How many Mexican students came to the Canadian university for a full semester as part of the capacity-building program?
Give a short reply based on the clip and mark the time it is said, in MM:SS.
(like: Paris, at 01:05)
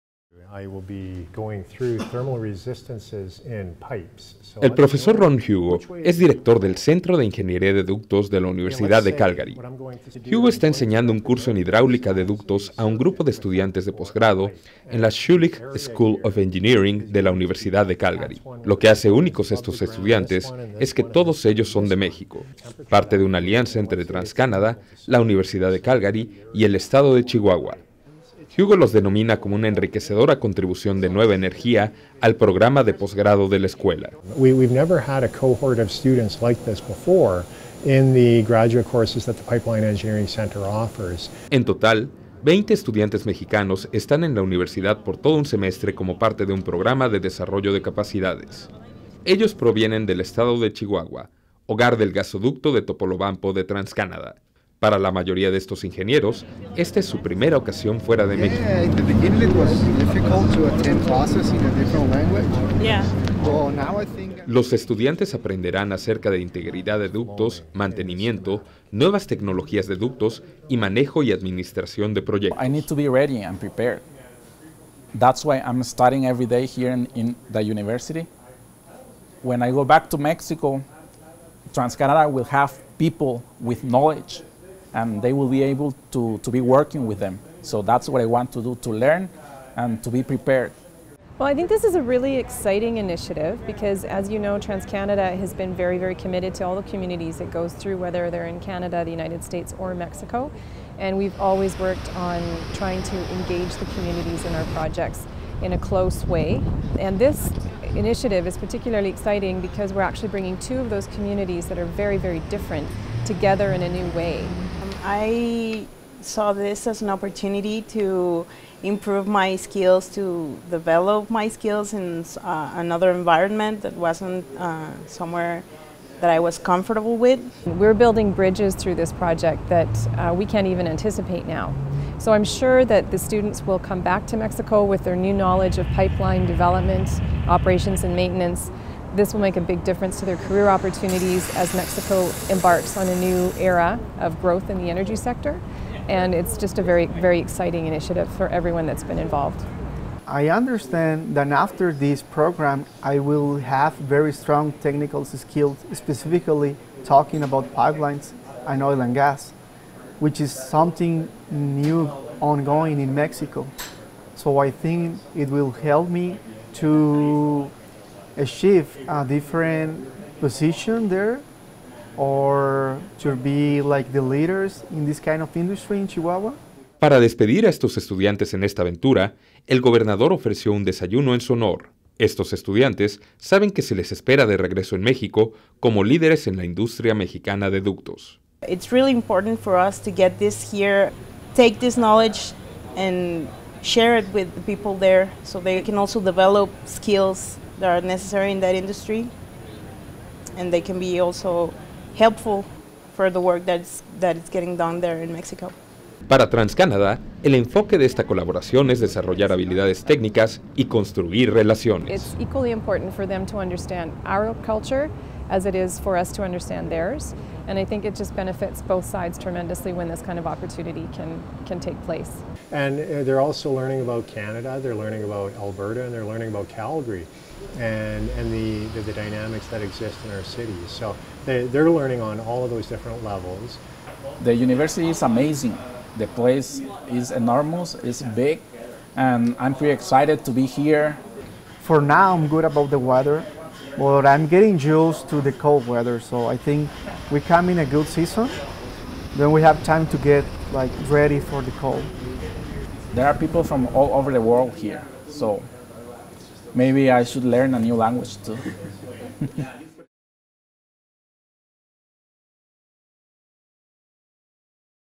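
20, at 00:42.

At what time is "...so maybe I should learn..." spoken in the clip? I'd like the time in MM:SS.
04:15.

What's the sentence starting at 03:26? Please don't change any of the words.
Para TransCanadá, el enfoque de esta colaboración es desarrollar habilidades técnicas y construir relaciones.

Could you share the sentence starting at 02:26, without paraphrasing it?
And it's just a very, very exciting initiative for everyone that's been involved.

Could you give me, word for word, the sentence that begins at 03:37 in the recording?
And I think it just benefits both sides tremendously when this kind of opportunity can, can take place.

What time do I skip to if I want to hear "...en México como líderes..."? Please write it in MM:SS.
03:04.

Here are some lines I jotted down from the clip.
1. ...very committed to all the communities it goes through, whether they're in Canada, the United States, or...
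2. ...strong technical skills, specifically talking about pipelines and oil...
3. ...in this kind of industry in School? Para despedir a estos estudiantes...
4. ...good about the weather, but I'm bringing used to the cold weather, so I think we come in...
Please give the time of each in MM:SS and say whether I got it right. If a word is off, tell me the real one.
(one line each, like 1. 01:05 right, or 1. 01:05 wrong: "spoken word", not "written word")
1. 01:35 right
2. 02:34 right
3. 02:54 wrong: "Chihuahua", not "School"
4. 04:02 wrong: "getting", not "bringing".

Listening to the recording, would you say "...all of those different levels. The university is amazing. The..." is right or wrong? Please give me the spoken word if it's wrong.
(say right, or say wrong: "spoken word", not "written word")
right.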